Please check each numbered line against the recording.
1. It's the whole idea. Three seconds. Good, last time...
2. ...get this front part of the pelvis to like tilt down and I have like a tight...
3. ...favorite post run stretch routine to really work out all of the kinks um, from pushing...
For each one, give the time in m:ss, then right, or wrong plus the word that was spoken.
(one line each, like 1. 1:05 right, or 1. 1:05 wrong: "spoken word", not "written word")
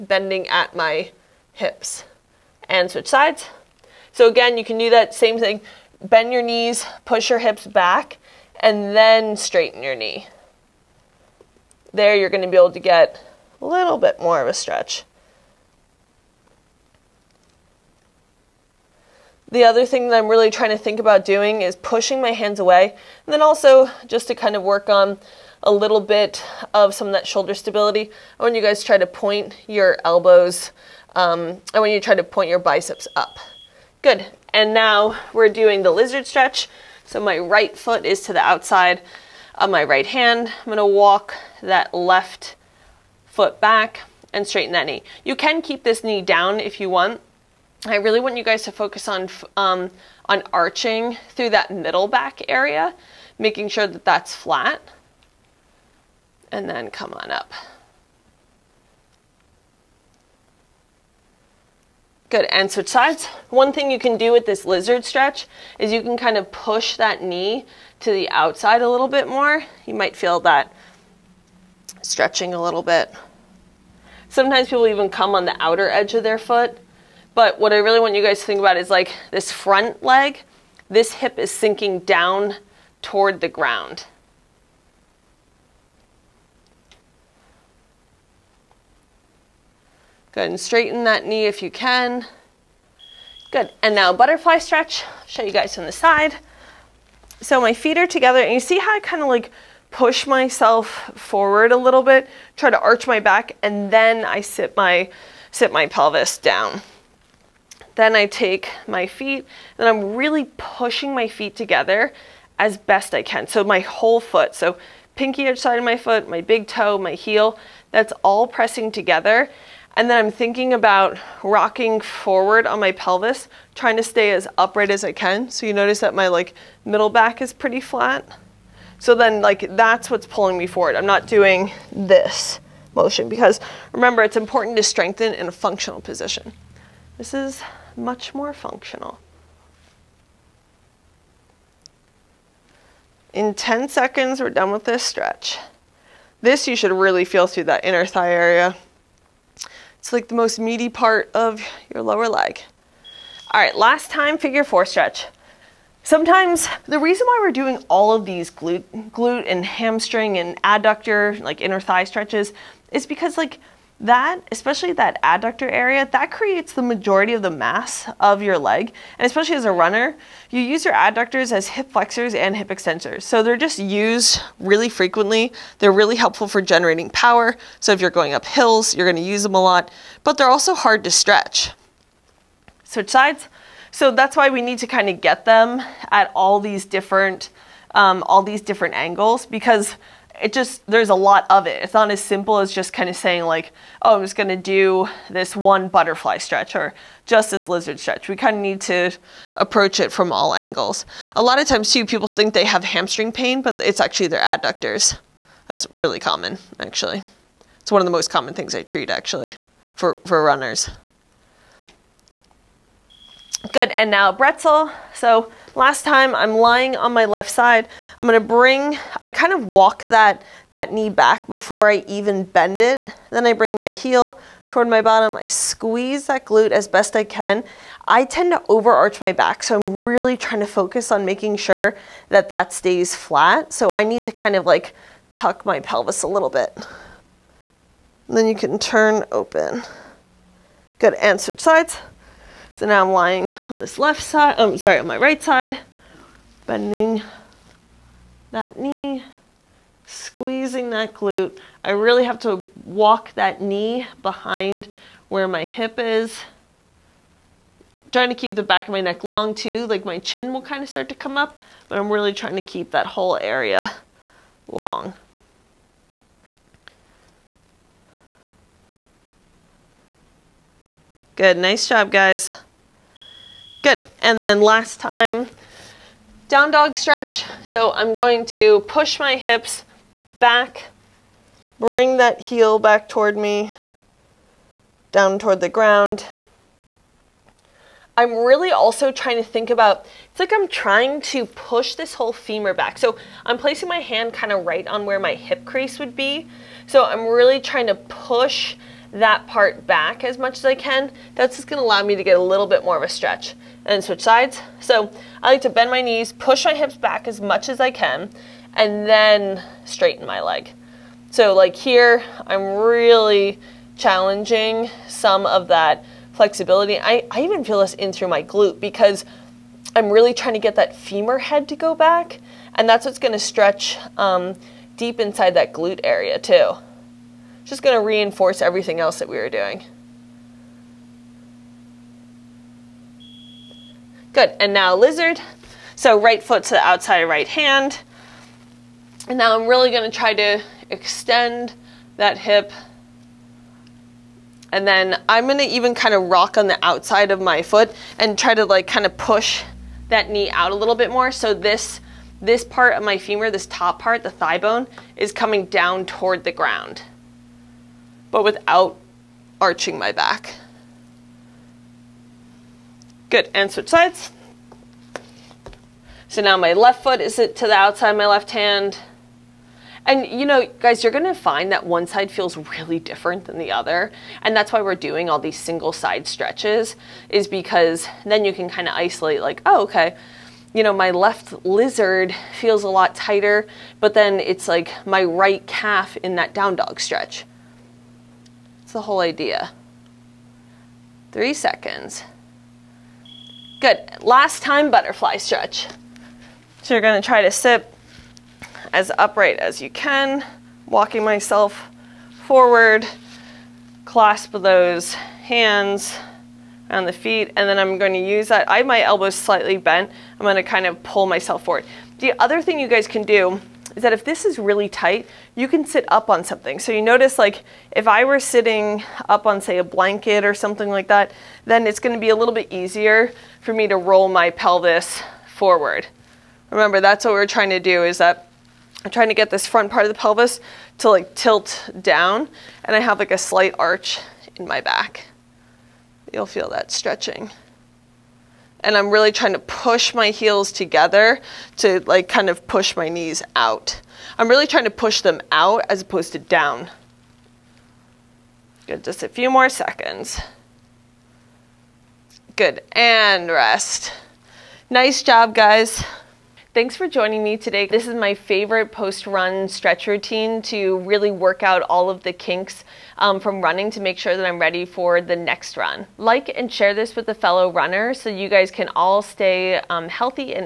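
1. 6:28 right
2. 7:09 wrong: "slight", not "tight"
3. 7:38 wrong: "running", not "pushing".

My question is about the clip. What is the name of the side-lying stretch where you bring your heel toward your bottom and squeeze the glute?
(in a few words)
Bretzel.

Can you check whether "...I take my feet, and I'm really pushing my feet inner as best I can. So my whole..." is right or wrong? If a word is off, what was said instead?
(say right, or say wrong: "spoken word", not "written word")
wrong: "together", not "inner".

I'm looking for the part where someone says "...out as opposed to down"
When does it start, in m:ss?
7:25.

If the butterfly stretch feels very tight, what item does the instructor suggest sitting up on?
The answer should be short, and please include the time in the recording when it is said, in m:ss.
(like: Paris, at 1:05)
A blanket, at 6:59.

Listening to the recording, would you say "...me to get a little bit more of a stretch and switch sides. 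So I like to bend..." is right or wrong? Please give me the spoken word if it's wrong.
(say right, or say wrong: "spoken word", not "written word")
right.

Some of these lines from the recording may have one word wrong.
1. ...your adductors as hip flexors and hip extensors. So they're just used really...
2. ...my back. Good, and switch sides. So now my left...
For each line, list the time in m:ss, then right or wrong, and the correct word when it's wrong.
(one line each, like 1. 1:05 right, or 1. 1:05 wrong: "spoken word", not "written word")
1. 2:50 right
2. 5:59 right.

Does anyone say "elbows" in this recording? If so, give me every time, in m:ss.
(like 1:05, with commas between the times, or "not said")
0:30, 6:49.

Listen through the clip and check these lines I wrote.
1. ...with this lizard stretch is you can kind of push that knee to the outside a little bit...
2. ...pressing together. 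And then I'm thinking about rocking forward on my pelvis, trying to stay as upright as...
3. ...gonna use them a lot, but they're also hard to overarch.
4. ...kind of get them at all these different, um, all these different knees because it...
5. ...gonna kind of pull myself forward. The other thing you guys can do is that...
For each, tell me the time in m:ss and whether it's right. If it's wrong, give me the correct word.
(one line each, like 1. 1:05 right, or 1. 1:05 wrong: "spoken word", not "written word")
1. 1:04 right
2. 1:58 right
3. 2:59 wrong: "stretch", not "overarch"
4. 3:04 wrong: "angles", not "knees"
5. 6:50 right.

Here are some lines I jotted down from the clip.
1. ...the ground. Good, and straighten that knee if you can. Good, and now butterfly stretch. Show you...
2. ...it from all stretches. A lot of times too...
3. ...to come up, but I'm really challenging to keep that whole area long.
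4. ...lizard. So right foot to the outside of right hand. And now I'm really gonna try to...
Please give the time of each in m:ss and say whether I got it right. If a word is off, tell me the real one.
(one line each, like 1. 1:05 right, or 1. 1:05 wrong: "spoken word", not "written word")
1. 1:23 right
2. 3:19 wrong: "angles", not "stretches"
3. 4:21 wrong: "trying", not "challenging"
4. 5:34 right.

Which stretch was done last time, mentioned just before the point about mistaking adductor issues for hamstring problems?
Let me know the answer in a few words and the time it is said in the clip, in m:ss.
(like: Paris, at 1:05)
Figure four stretch, at 2:34.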